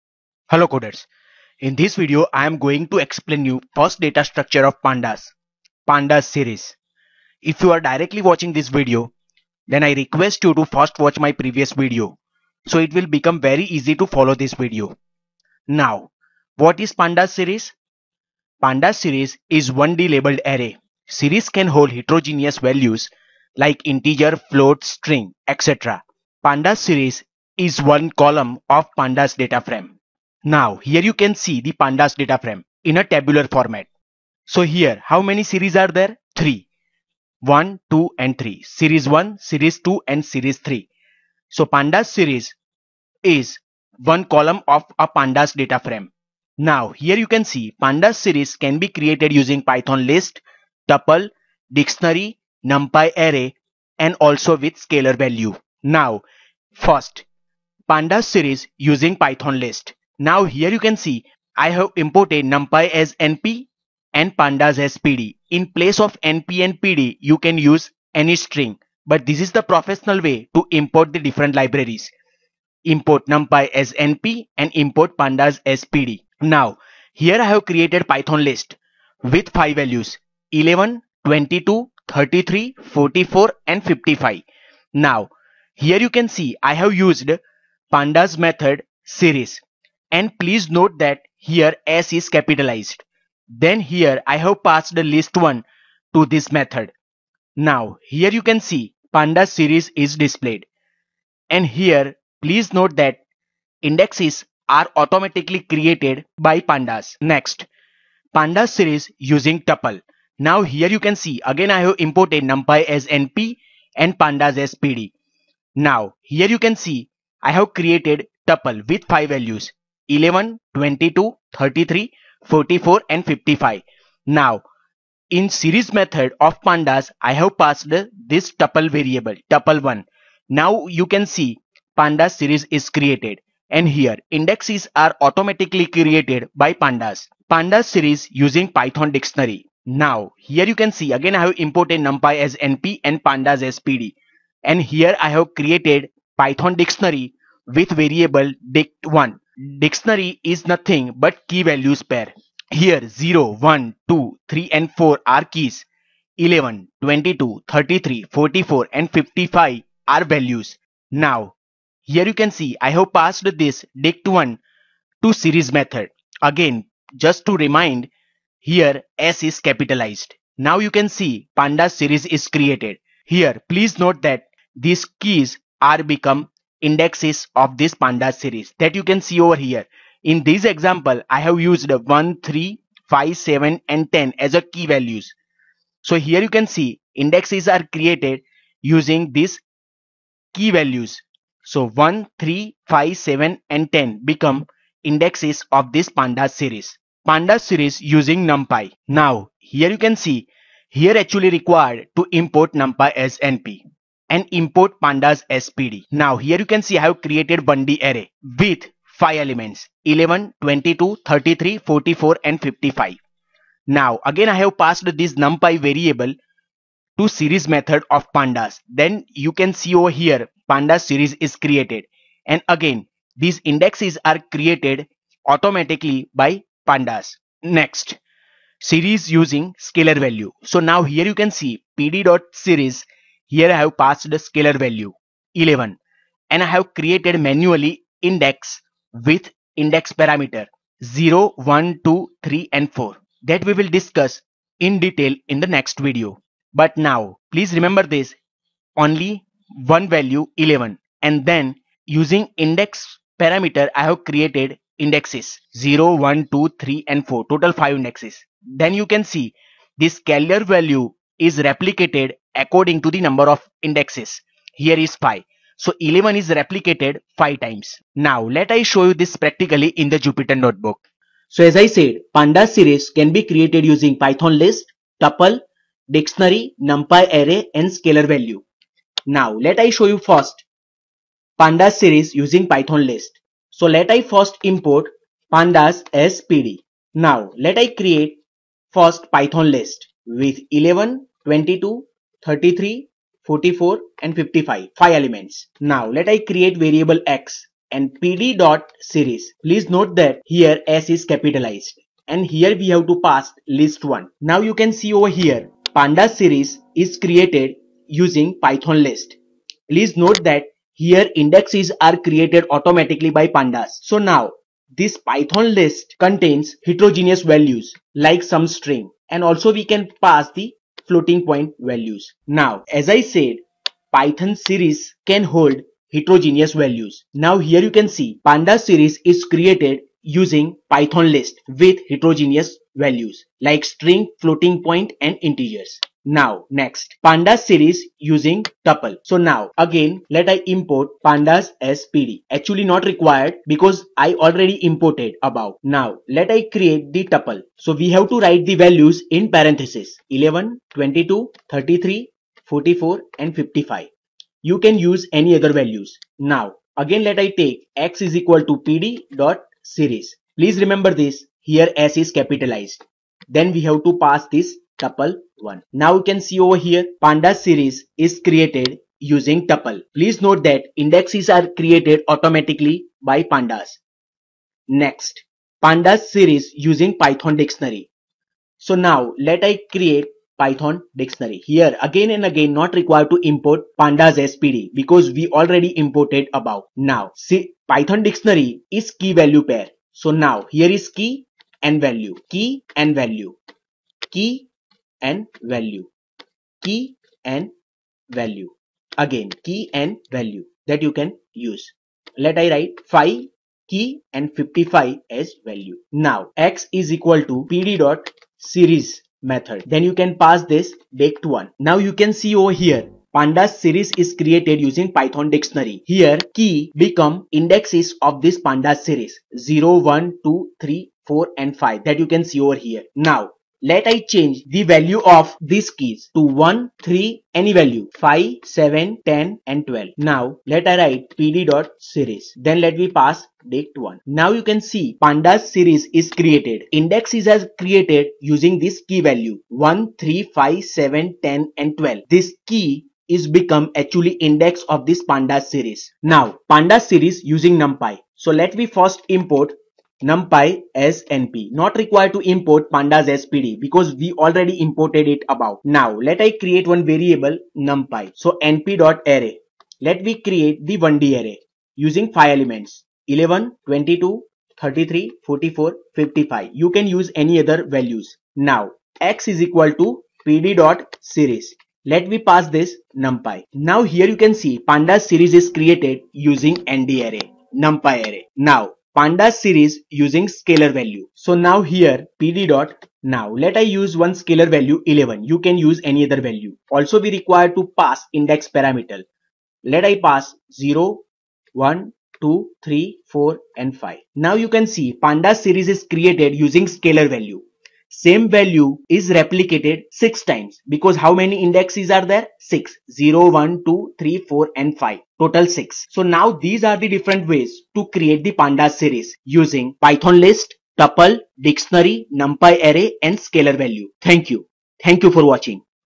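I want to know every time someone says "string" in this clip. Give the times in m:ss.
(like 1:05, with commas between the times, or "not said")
0:24, 1:08, 5:18, 5:33.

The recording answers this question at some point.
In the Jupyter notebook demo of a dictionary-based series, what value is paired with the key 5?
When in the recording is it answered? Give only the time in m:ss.
6:44.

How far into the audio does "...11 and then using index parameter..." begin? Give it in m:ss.
4:10.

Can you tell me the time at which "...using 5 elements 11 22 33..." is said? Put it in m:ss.
7:42.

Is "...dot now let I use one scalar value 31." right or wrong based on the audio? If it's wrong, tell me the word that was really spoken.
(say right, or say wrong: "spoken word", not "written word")
wrong: "11", not "31".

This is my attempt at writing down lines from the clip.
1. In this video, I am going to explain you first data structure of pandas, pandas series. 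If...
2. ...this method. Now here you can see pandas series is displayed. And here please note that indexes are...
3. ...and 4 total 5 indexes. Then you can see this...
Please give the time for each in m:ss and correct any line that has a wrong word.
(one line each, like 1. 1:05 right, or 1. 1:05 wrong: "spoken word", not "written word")
1. 0:01 right
2. 1:36 right
3. 4:17 right.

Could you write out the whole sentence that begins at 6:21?
Here again and again not required to import pandas SPD because we already imported above.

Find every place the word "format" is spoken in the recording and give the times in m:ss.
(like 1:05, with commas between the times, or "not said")
0:33.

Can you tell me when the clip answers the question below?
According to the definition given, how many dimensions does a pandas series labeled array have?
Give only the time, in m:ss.
0:19.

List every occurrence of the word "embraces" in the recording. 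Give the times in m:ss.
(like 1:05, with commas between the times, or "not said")
not said.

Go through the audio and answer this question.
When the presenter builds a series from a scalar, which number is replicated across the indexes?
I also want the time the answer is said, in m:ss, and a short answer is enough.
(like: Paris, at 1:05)
11, at 3:53.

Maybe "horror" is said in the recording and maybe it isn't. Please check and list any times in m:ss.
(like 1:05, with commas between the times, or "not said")
not said.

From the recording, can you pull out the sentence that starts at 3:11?
So 1, 3, 5, 7 and 10 become indexes of this pandas series.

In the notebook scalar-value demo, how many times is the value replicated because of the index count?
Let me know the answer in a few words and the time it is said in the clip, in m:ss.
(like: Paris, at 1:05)
6, at 8:19.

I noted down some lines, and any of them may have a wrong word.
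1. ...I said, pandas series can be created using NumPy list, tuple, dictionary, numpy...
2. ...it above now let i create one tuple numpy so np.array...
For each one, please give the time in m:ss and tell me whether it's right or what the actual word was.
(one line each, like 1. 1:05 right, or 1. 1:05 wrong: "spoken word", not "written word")
1. 4:31 wrong: "Python", not "NumPy"
2. 7:35 wrong: "variable", not "tuple".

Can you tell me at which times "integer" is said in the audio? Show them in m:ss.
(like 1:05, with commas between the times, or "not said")
0:23, 5:35.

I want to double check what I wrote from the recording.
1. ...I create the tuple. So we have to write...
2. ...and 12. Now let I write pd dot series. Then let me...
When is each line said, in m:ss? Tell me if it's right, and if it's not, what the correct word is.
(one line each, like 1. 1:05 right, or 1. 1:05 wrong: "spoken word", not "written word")
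1. 5:46 right
2. 7:09 right.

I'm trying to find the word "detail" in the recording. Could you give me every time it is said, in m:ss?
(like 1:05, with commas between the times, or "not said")
4:04.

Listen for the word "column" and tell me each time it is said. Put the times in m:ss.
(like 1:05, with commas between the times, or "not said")
0:28, 0:44.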